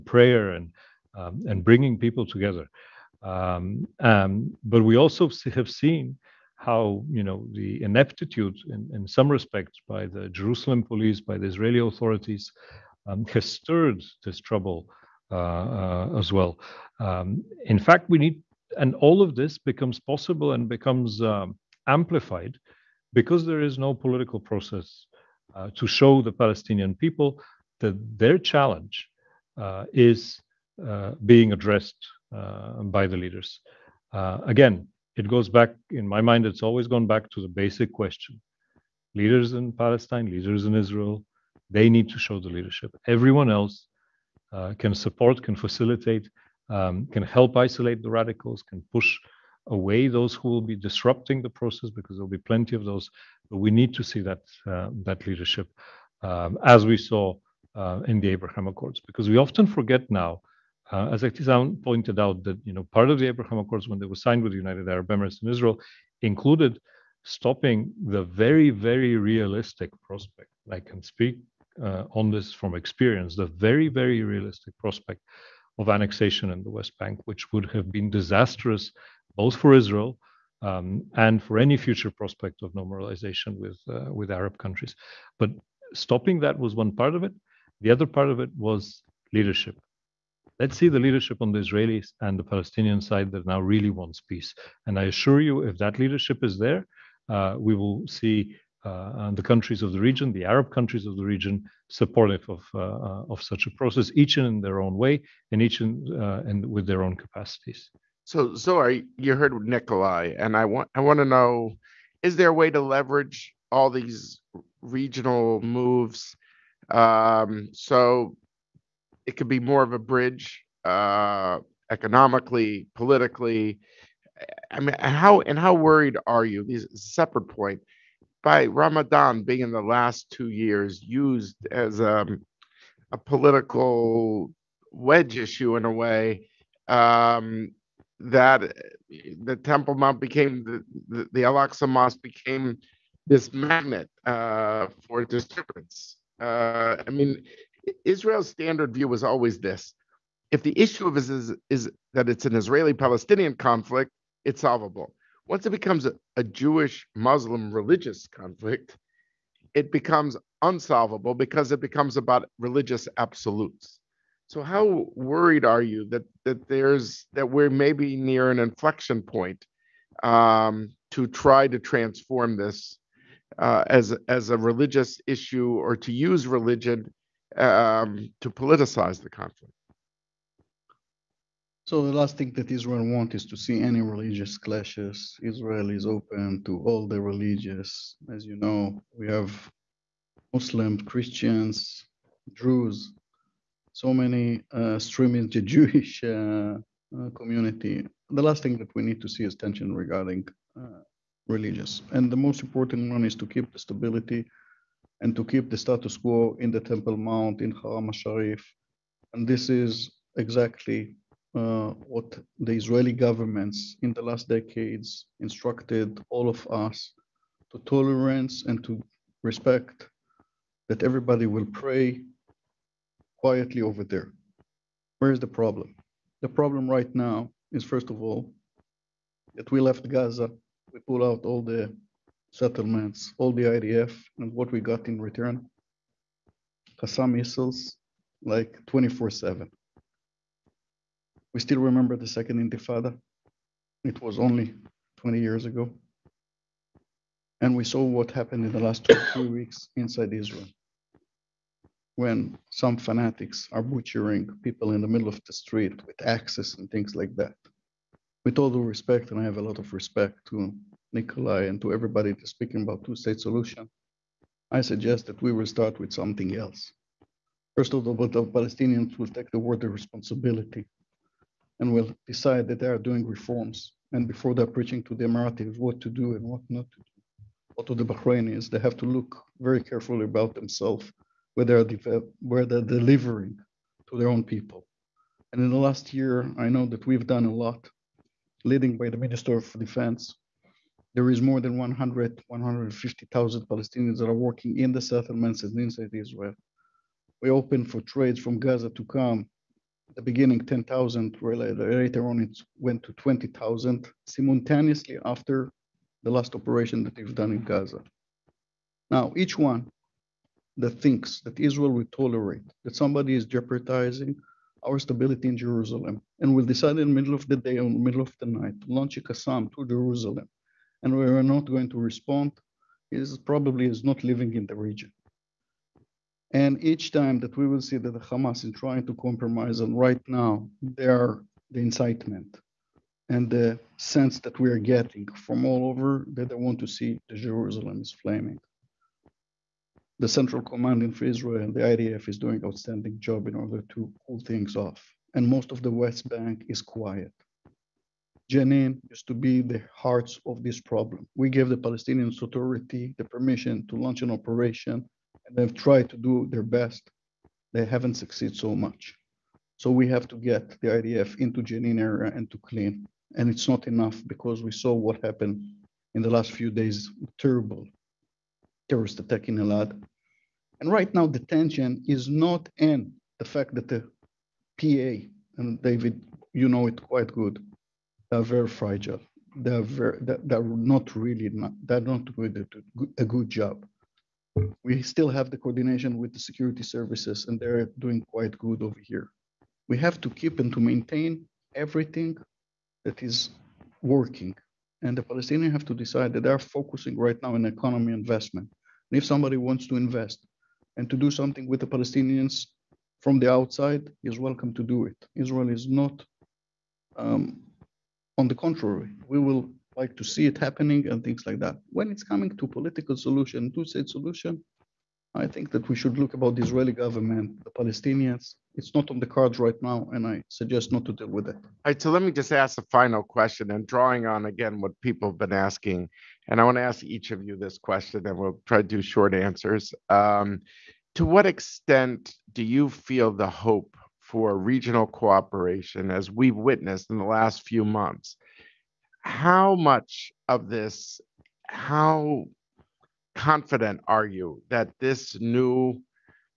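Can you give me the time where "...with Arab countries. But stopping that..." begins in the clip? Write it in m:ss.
1:24.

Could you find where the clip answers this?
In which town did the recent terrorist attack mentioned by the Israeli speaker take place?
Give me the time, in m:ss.
6:09.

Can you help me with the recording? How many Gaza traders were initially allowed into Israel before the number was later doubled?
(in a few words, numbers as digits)
10,000.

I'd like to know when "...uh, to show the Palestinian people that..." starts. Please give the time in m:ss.
0:25.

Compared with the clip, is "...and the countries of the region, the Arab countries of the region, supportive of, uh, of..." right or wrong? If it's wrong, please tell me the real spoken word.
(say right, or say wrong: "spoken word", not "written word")
right.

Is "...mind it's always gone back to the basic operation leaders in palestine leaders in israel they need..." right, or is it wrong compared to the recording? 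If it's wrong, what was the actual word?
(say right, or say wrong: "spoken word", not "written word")
wrong: "question", not "operation".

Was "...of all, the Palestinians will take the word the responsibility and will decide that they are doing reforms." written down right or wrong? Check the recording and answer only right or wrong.
right.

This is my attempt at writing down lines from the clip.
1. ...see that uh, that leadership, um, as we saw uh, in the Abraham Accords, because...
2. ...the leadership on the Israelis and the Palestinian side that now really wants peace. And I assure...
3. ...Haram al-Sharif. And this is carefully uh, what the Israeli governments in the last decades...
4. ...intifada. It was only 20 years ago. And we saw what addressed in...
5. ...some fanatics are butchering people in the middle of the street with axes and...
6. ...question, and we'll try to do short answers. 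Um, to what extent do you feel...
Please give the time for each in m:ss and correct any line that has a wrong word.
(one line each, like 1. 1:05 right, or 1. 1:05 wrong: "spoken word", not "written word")
1. 0:54 right
2. 1:30 right
3. 3:27 wrong: "exactly", not "carefully"
4. 4:02 wrong: "happened", not "addressed"
5. 4:12 right
6. 7:07 right.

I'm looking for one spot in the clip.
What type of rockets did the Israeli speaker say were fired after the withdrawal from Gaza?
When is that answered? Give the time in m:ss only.
3:56.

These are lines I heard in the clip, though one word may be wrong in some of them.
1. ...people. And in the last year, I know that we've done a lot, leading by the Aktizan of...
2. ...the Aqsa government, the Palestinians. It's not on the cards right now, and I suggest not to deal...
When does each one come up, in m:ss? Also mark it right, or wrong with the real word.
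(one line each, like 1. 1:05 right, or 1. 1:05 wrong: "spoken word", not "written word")
1. 4:44 wrong: "Minister", not "Aktizan"
2. 6:56 wrong: "Israeli", not "Aqsa".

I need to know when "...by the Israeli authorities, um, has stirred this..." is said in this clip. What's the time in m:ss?
0:11.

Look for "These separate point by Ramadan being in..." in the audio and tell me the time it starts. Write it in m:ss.
2:06.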